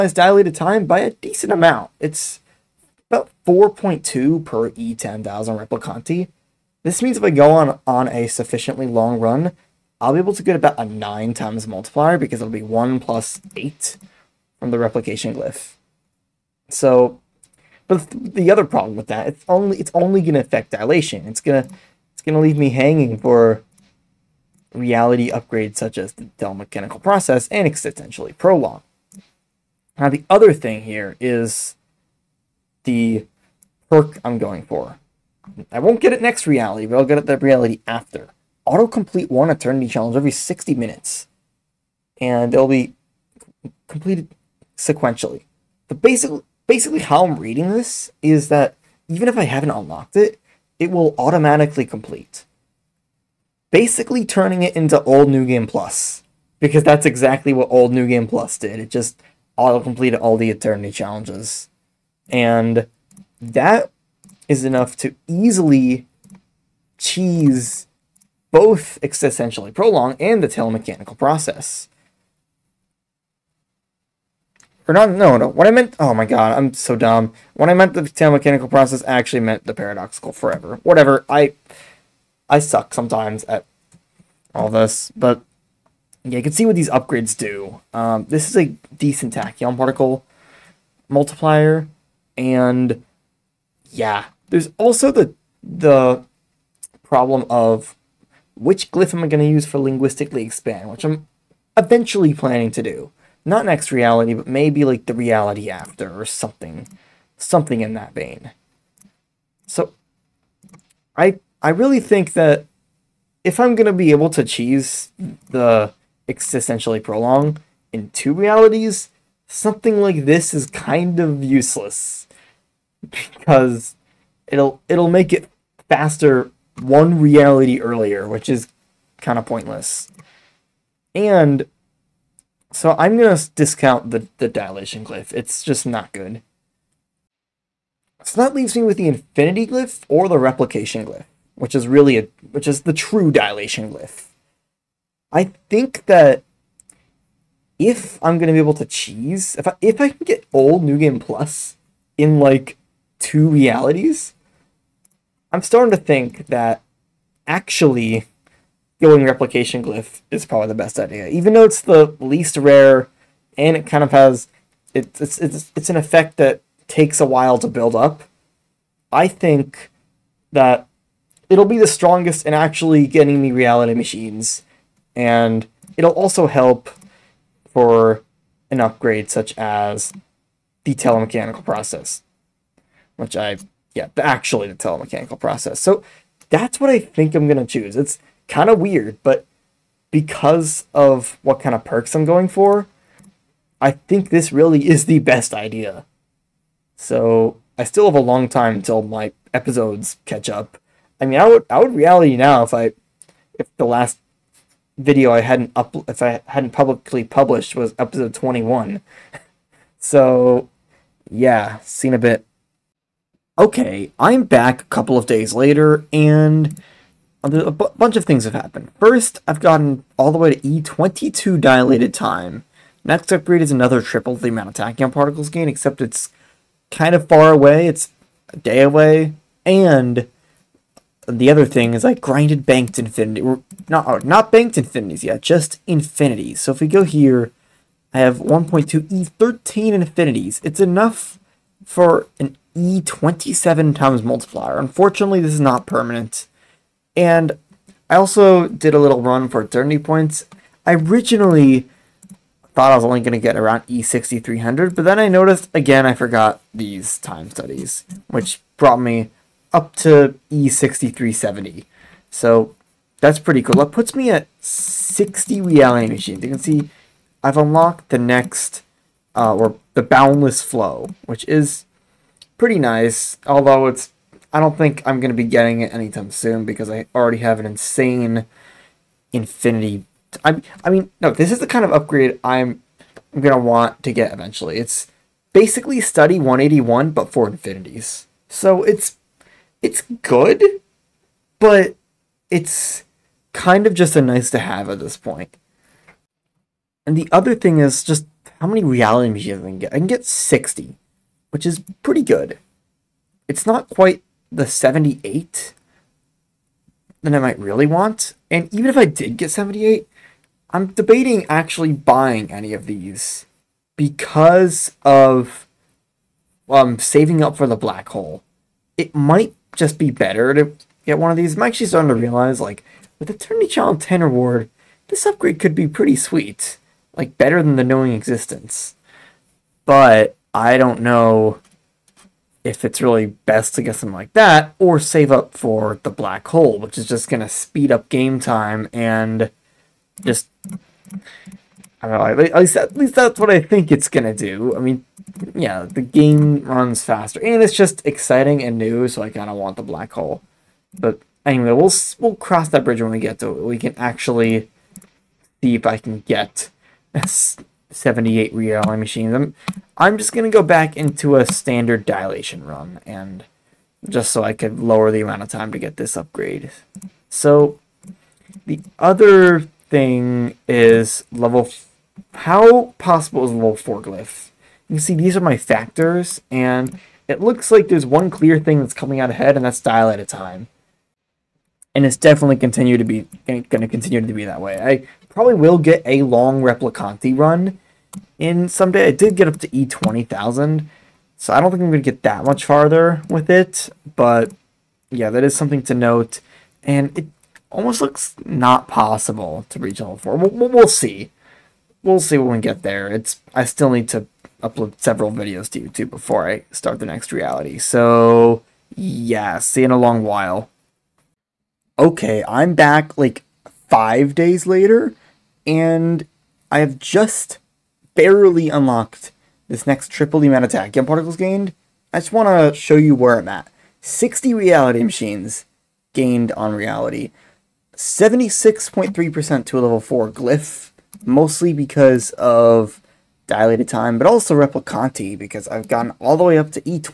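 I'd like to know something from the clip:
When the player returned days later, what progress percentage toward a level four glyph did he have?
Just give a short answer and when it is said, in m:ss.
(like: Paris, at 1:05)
76.3%, at 7:07.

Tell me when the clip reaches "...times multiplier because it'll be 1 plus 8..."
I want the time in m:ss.
0:11.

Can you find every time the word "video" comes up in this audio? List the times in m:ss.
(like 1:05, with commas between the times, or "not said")
3:24, 6:45.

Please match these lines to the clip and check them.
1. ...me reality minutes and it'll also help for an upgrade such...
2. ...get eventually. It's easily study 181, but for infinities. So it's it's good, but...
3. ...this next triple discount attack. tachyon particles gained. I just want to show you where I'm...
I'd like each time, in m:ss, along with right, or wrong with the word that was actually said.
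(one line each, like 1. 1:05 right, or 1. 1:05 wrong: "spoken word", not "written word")
1. 2:53 wrong: "machines", not "minutes"
2. 4:44 wrong: "basically", not "easily"
3. 6:59 wrong: "amount", not "discount".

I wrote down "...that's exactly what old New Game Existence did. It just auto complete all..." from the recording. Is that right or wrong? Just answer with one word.
wrong.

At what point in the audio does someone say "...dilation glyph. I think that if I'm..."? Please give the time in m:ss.
2:23.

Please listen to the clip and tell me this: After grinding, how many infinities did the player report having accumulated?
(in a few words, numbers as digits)
1.2 E13.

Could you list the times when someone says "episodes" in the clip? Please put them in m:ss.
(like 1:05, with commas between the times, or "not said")
3:19, 3:27.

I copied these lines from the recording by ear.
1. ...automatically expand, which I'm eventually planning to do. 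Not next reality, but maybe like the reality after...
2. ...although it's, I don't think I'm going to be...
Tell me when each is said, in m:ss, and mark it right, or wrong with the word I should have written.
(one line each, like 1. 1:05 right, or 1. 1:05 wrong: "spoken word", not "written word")
1. 1:39 wrong: "linguistically", not "automatically"
2. 4:33 right.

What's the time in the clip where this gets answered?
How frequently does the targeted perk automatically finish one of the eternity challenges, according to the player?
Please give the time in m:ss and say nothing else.
0:40.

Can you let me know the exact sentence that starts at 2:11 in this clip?
And so I'm gonna discount the the dilation glyph.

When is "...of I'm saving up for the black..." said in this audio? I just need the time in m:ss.
5:15.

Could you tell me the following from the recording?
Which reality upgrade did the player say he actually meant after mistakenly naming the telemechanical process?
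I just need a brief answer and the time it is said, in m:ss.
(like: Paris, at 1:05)
paradoxical forever, at 1:19.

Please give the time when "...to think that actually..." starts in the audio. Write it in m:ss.
2:35.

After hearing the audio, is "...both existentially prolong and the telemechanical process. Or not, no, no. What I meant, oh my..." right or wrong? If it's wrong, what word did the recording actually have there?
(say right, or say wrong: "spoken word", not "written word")
right.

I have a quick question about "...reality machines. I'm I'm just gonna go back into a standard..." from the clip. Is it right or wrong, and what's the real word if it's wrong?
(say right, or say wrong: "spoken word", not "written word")
right.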